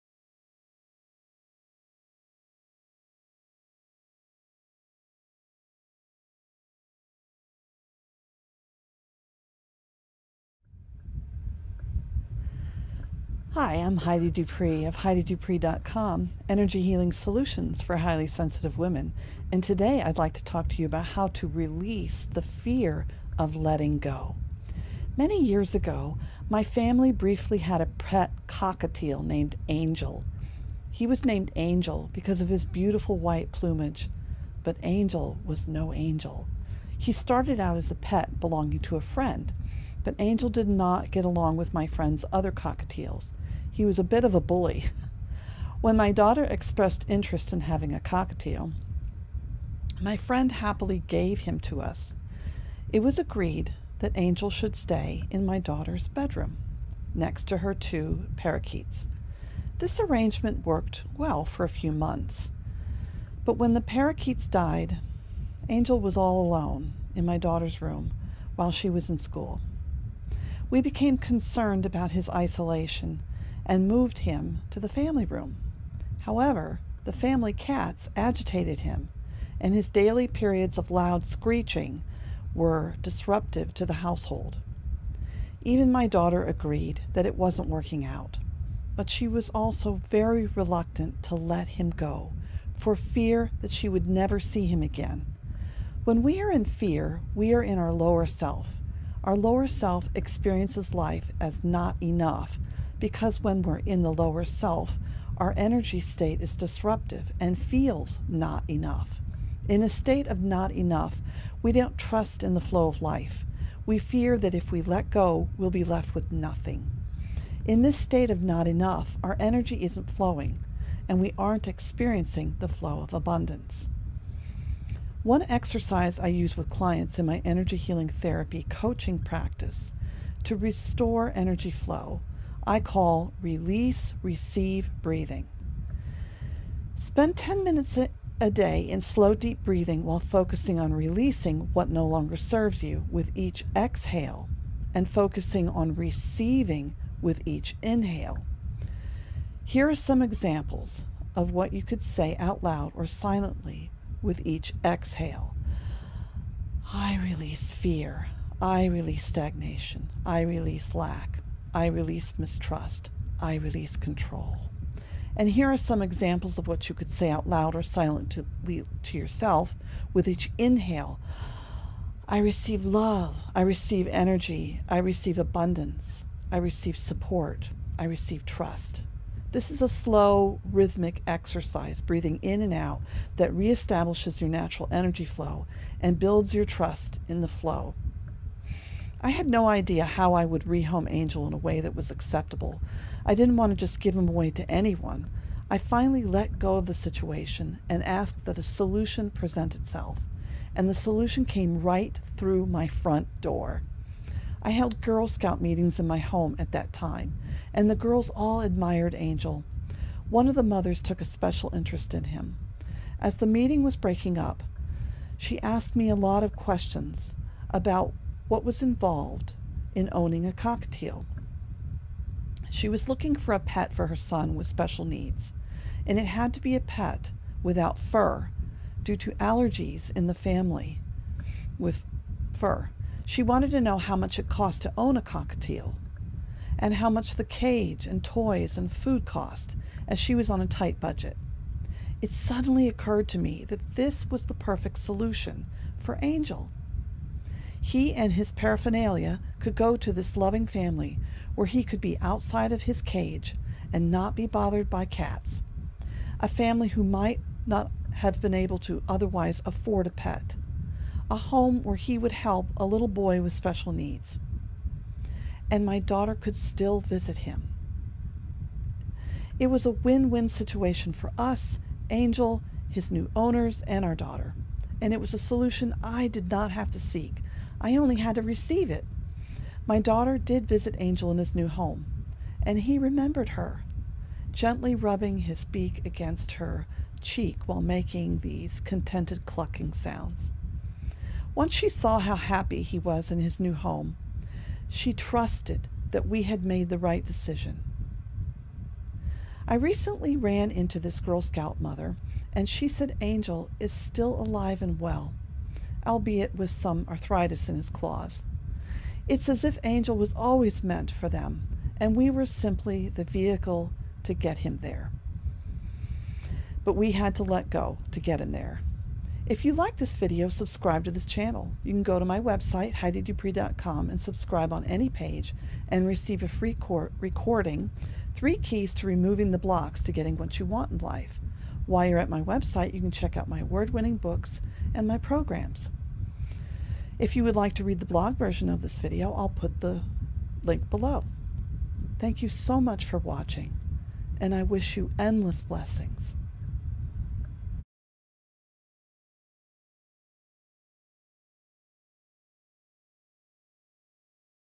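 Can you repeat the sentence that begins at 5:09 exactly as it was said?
It's as if Angel was always meant for them, and we were simply the vehicle to get him there.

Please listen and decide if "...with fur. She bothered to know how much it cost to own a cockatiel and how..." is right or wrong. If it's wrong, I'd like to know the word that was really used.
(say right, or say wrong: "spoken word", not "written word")
wrong: "wanted", not "bothered".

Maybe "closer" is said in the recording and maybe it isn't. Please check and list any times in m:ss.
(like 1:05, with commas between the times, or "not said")
not said.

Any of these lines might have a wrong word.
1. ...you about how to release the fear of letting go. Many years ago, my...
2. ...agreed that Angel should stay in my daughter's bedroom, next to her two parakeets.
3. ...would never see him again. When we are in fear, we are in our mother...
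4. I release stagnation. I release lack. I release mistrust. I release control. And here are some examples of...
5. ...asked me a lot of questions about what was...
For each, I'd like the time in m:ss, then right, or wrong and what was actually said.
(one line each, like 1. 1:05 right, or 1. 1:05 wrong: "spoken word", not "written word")
1. 0:20 right
2. 0:53 right
3. 1:33 wrong: "lower", not "mother"
4. 2:38 right
5. 3:35 right.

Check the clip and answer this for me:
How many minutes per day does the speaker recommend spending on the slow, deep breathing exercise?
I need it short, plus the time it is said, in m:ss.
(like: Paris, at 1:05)
10, at 2:17.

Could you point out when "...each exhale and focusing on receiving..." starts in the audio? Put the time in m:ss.
2:23.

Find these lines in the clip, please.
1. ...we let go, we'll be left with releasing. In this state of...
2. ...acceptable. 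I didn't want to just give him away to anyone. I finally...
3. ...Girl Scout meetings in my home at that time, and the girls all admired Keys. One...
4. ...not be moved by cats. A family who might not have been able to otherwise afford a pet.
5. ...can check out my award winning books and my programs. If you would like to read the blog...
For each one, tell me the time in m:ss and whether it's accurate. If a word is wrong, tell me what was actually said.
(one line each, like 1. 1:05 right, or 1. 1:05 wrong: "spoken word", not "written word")
1. 1:54 wrong: "nothing", not "releasing"
2. 3:12 right
3. 3:25 wrong: "Angel", not "Keys"
4. 4:14 wrong: "bothered", not "moved"
5. 5:33 right.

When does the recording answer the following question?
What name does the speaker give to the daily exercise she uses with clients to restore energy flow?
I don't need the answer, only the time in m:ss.
2:13.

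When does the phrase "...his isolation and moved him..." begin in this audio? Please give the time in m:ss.
1:12.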